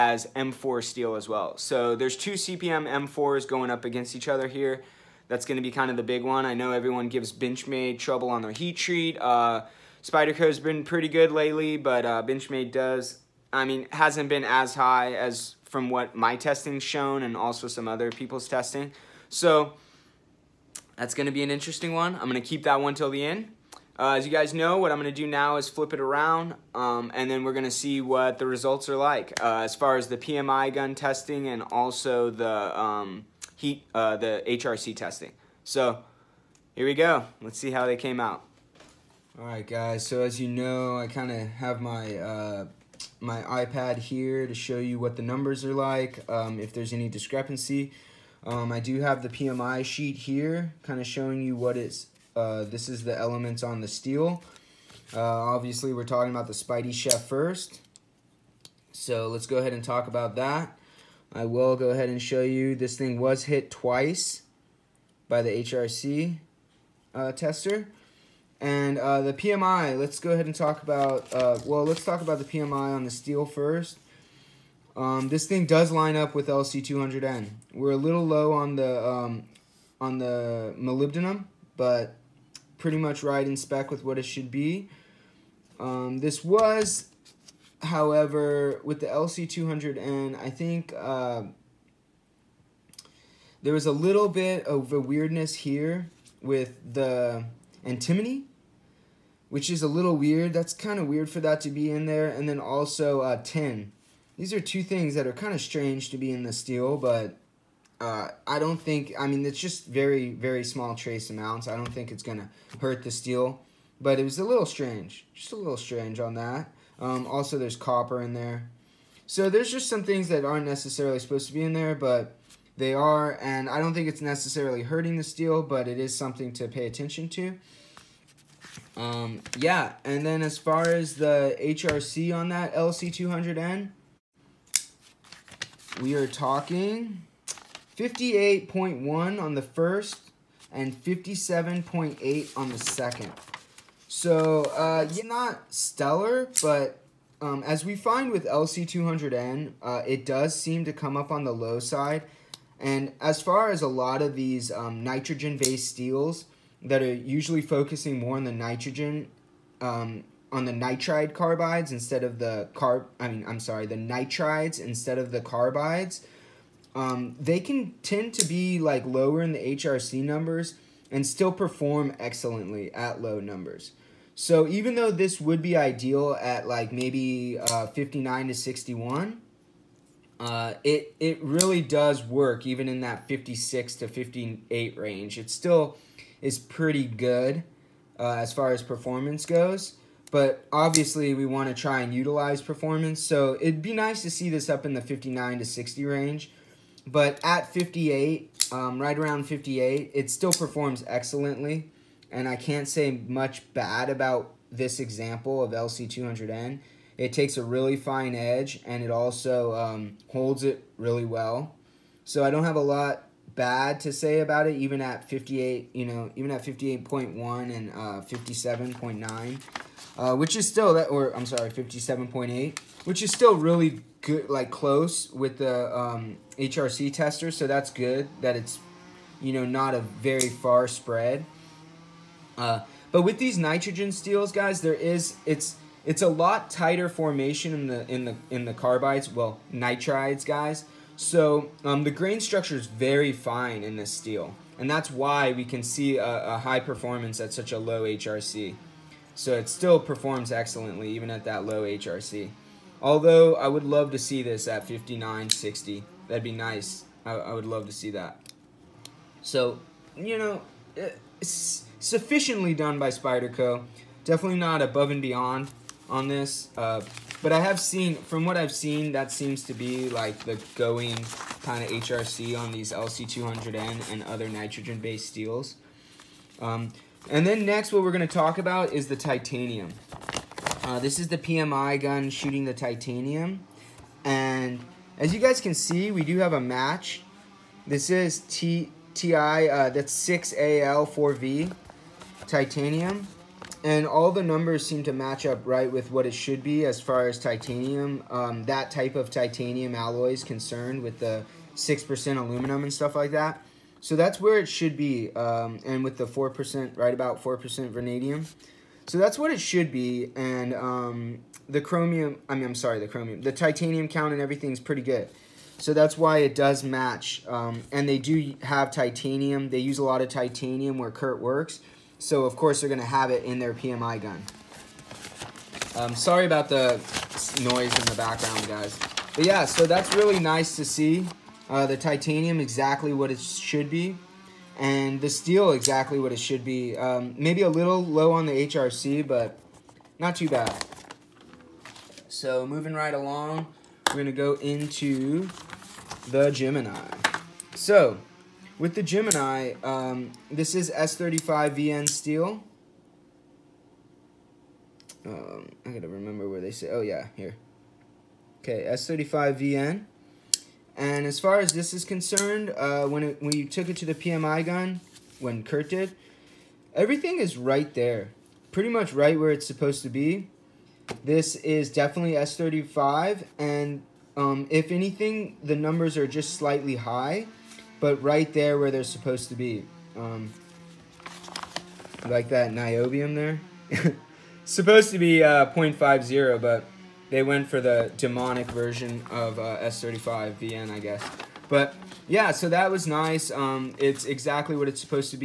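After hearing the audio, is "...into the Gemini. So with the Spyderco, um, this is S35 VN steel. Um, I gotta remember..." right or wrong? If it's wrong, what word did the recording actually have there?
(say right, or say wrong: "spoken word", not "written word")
wrong: "Gemini", not "Spyderco".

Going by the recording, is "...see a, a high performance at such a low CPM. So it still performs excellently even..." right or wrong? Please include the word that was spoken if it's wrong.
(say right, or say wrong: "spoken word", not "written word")
wrong: "HRC", not "CPM".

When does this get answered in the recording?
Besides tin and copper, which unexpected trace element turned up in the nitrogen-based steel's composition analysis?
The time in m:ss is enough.
1:37.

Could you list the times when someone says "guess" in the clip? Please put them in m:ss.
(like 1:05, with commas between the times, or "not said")
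6:30.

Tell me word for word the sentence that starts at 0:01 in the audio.
So there's two CPM M4s going up against each other here.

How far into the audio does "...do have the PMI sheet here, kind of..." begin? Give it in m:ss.
0:48.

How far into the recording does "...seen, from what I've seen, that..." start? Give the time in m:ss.
4:27.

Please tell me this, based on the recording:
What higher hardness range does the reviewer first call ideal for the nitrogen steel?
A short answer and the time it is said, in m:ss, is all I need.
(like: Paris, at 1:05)
59 to 61, at 2:57.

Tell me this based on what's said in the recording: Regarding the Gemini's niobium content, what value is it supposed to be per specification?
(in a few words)
0.50.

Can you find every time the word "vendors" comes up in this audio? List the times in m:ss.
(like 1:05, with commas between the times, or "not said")
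not said.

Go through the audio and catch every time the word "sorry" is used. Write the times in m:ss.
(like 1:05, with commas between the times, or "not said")
2:43, 3:41, 5:12, 5:26.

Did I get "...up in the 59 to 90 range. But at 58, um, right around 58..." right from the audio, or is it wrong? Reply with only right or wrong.
wrong.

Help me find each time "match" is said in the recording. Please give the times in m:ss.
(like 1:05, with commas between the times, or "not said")
4:46, 4:55, 5:16.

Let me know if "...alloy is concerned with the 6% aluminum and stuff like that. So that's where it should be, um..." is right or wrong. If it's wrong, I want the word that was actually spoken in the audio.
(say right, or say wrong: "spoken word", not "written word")
right.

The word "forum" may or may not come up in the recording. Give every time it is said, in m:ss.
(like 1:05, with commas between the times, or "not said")
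not said.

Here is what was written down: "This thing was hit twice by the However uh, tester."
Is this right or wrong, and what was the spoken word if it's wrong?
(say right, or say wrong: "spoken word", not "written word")
wrong: "HRC", not "However".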